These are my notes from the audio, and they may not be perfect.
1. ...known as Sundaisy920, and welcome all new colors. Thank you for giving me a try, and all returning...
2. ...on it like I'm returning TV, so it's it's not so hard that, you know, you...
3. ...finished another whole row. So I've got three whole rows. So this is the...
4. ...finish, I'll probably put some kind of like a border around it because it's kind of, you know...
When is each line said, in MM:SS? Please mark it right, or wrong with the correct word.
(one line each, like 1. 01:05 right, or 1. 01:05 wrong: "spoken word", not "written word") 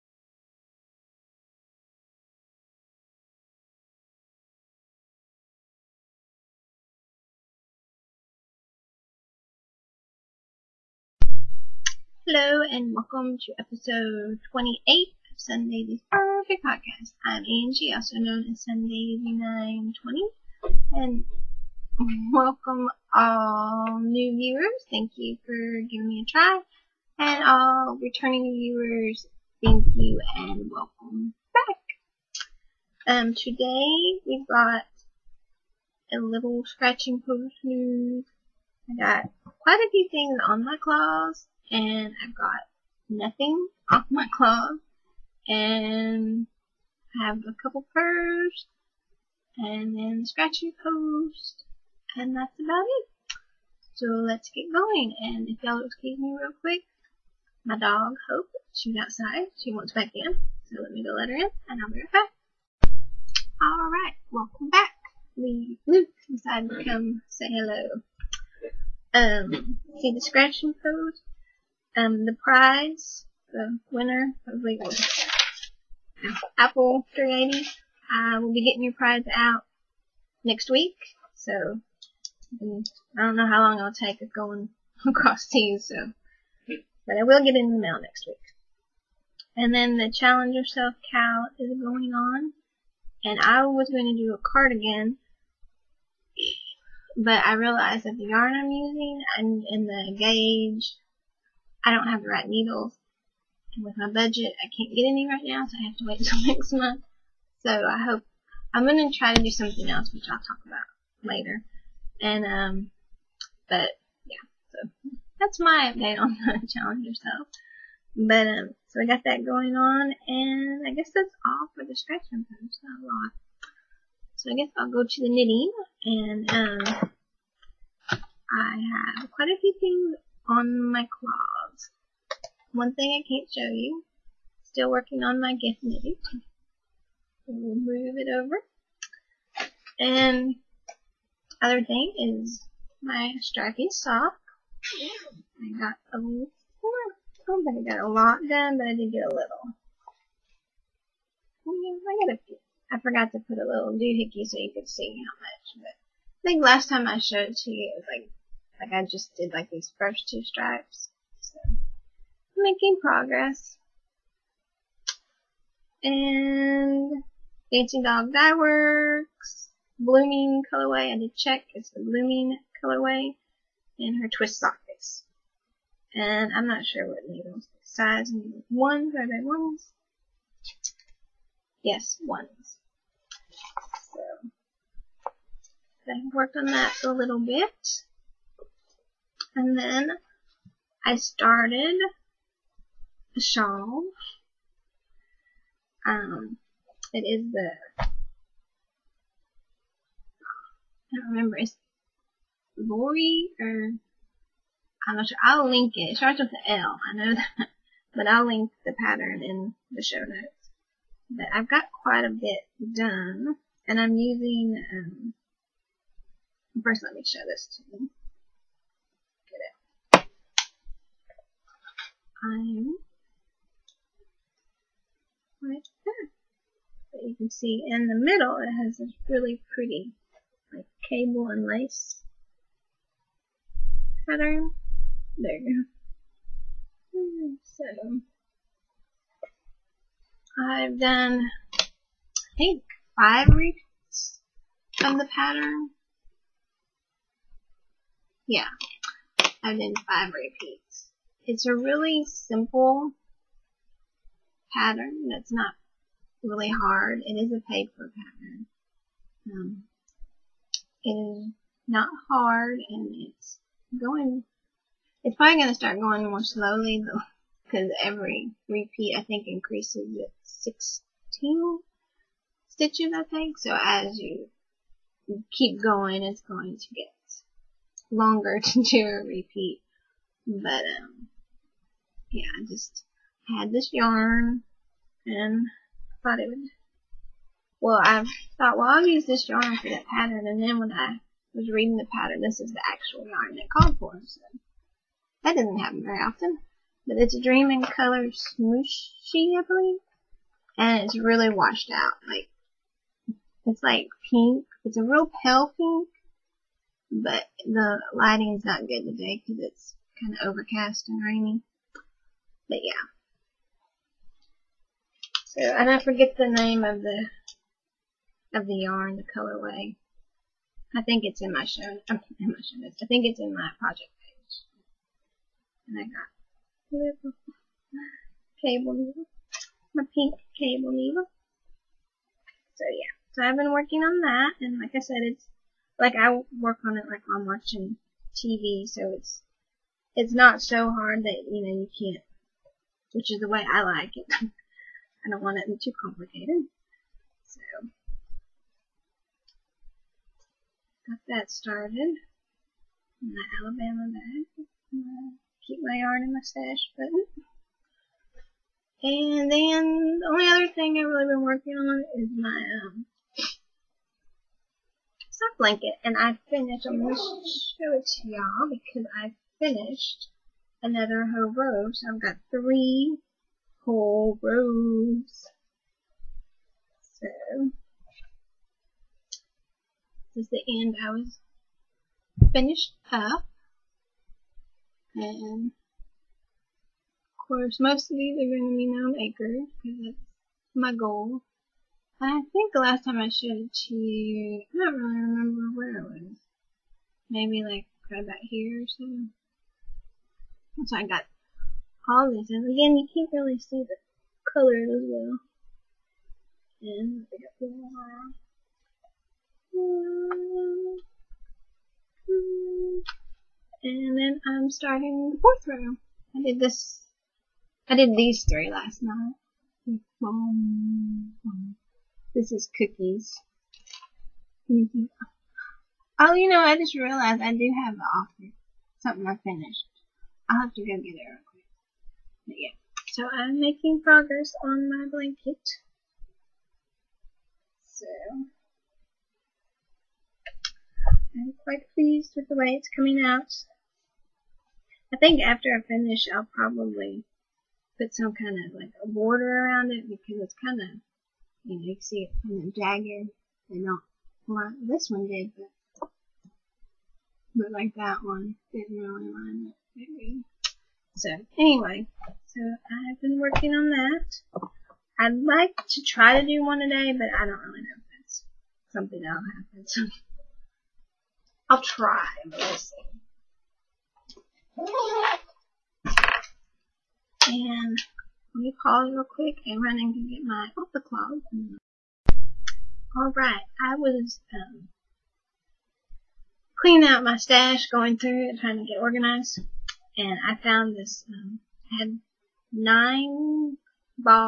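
1. 00:18 wrong: "viewers", not "colors"
2. 05:36 wrong: "watching", not "returning"
3. 06:09 right
4. 07:25 right.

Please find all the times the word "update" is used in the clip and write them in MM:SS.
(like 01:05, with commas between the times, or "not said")
01:55.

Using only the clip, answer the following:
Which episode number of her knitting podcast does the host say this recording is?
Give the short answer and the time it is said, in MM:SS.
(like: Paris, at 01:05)
28, at 00:13.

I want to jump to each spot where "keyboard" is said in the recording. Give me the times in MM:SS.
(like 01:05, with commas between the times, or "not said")
not said.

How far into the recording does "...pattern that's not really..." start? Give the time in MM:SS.
04:14.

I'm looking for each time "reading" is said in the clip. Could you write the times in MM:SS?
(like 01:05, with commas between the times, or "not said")
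04:51.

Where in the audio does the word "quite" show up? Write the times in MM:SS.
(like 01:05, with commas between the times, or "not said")
00:39, 02:09, 03:32, 07:21.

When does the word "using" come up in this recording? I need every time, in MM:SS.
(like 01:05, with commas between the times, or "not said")
01:38, 03:34.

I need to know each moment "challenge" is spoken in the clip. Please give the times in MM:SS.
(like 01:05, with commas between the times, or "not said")
01:30, 01:56.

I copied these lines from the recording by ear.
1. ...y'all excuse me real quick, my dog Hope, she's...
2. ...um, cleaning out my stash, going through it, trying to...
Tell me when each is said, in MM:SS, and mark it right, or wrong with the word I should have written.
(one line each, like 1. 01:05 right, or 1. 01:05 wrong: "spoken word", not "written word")
1. 00:55 right
2. 08:04 right.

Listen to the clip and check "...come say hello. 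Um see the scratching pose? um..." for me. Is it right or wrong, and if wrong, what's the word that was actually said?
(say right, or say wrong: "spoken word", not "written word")
right.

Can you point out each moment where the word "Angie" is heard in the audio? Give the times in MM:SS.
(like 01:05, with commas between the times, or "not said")
00:17.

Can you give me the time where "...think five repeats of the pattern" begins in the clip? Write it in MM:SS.
04:02.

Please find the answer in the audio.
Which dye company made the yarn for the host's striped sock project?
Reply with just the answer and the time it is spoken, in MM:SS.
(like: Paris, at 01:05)
Dancing Dog Dye Works, at 02:47.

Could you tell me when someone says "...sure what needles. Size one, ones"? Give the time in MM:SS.
02:56.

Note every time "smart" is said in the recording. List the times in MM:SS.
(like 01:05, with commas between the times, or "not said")
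not said.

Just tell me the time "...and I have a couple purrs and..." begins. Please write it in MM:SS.
00:45.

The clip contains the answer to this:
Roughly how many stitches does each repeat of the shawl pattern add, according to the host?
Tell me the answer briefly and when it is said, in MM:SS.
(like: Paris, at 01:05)
16, at 04:30.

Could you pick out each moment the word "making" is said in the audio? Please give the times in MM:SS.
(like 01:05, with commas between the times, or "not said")
02:42, 07:13.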